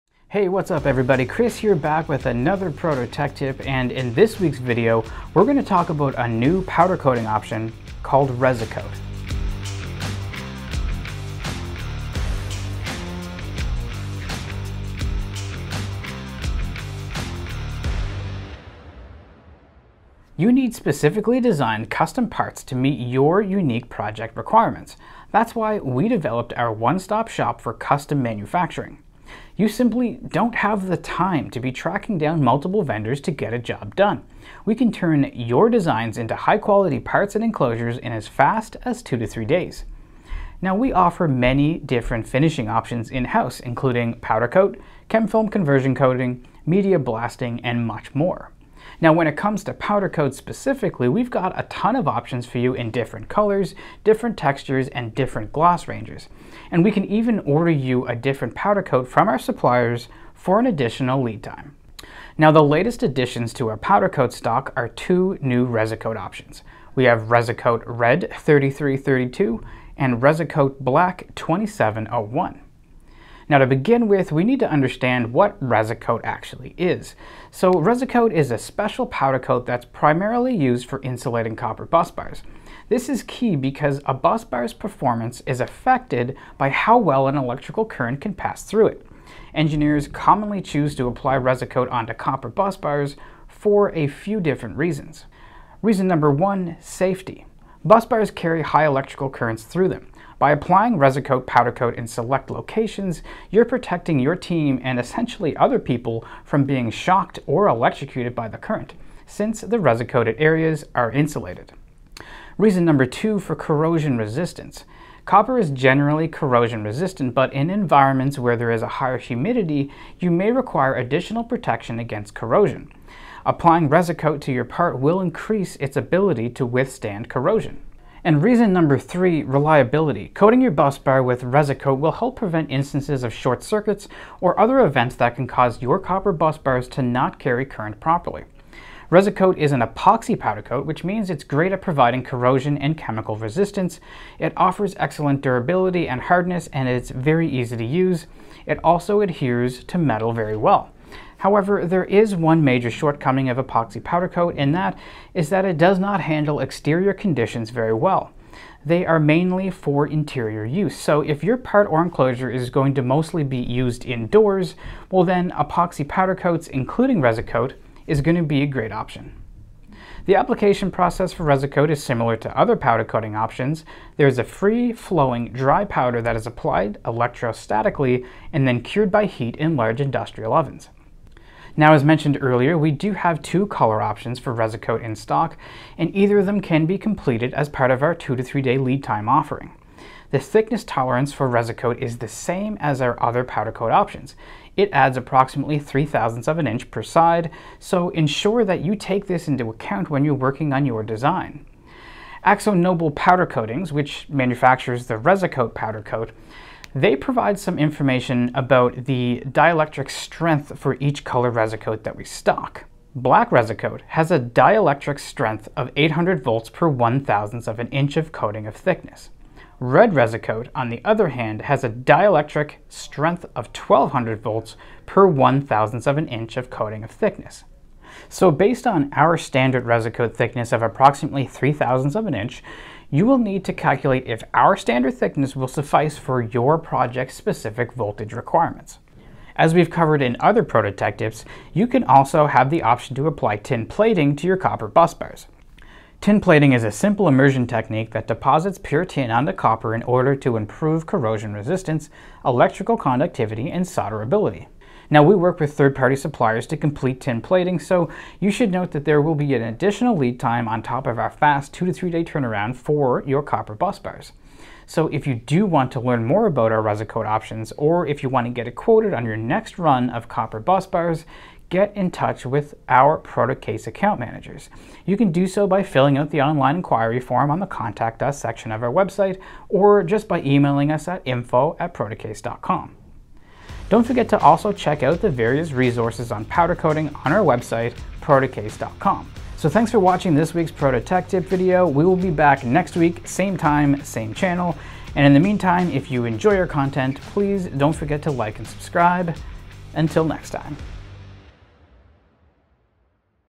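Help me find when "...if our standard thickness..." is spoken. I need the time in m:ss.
3:54.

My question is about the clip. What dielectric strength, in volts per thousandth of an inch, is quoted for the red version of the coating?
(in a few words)
1200.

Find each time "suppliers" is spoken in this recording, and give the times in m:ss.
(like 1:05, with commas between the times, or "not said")
0:59, 4:16.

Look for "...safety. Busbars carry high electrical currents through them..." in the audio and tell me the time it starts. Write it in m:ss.
1:36.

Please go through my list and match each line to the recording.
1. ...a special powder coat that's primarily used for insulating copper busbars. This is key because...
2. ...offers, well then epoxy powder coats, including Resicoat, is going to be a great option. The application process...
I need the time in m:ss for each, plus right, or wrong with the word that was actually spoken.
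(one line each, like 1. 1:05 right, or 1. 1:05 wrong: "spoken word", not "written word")
1. 1:18 right
2. 2:44 wrong: "indoors", not "offers".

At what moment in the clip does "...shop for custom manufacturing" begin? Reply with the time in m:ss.
0:27.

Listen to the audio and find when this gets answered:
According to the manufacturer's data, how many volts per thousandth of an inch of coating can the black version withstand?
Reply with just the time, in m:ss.
3:35.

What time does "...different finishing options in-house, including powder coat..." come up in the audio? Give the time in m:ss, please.
0:41.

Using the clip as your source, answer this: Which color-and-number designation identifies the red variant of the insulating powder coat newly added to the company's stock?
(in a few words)
Red 3332.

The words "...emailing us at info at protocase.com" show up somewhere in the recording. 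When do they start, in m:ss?
4:40.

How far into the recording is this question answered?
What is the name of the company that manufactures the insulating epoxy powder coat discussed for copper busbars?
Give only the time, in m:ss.
3:22.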